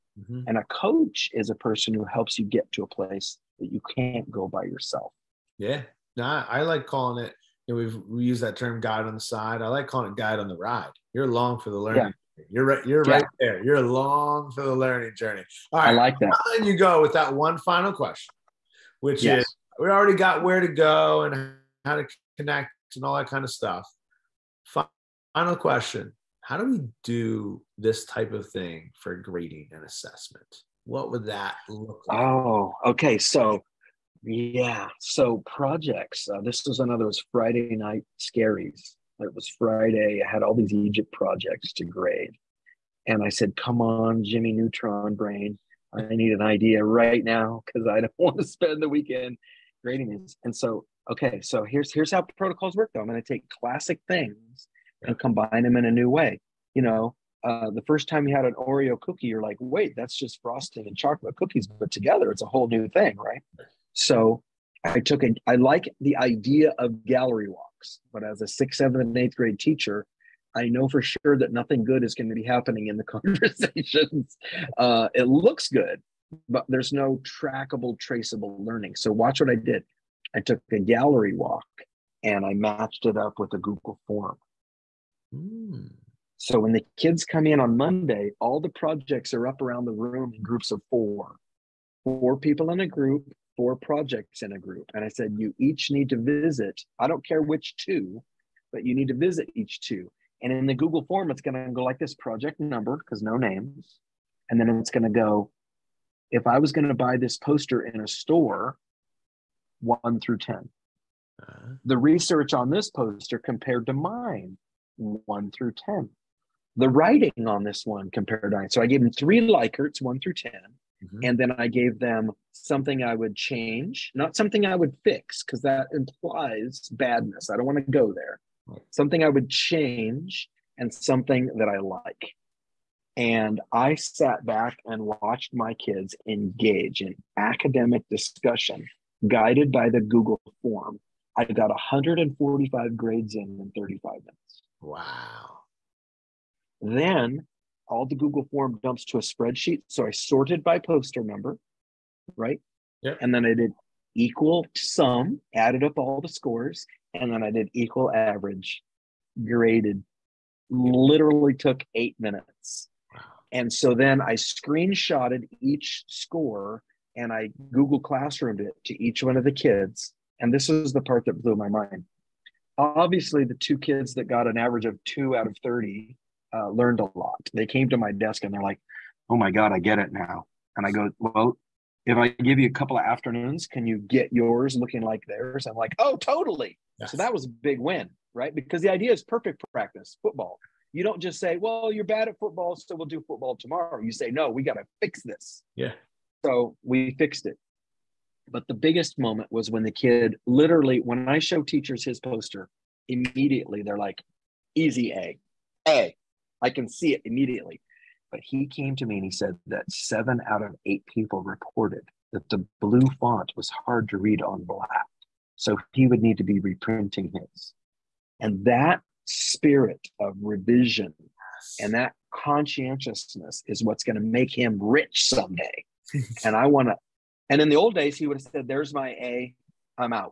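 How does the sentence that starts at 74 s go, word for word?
Uh, it looks good, but there's no trackable, traceable learning.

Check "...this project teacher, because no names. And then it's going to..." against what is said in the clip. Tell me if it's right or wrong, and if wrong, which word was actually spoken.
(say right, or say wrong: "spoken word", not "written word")
wrong: "number", not "teacher".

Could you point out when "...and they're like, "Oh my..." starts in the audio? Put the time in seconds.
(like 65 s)
178 s.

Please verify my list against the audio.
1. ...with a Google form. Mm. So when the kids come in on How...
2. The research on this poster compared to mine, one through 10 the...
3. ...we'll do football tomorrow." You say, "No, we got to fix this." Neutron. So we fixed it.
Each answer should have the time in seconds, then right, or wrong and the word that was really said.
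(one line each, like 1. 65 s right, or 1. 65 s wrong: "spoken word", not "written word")
1. 83 s wrong: "Monday", not "How"
2. 111 s right
3. 192 s wrong: "Yeah", not "Neutron".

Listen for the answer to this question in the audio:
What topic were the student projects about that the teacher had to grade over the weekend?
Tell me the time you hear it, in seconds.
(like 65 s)
40 s.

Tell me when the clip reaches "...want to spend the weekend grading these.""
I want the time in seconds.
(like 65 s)
48 s.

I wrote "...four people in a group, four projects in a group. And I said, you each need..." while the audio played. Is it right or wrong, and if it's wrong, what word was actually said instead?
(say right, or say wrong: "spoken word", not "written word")
right.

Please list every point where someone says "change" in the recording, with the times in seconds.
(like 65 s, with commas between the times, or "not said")
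123 s, 129 s.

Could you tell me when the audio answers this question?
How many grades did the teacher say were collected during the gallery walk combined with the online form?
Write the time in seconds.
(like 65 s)
141 s.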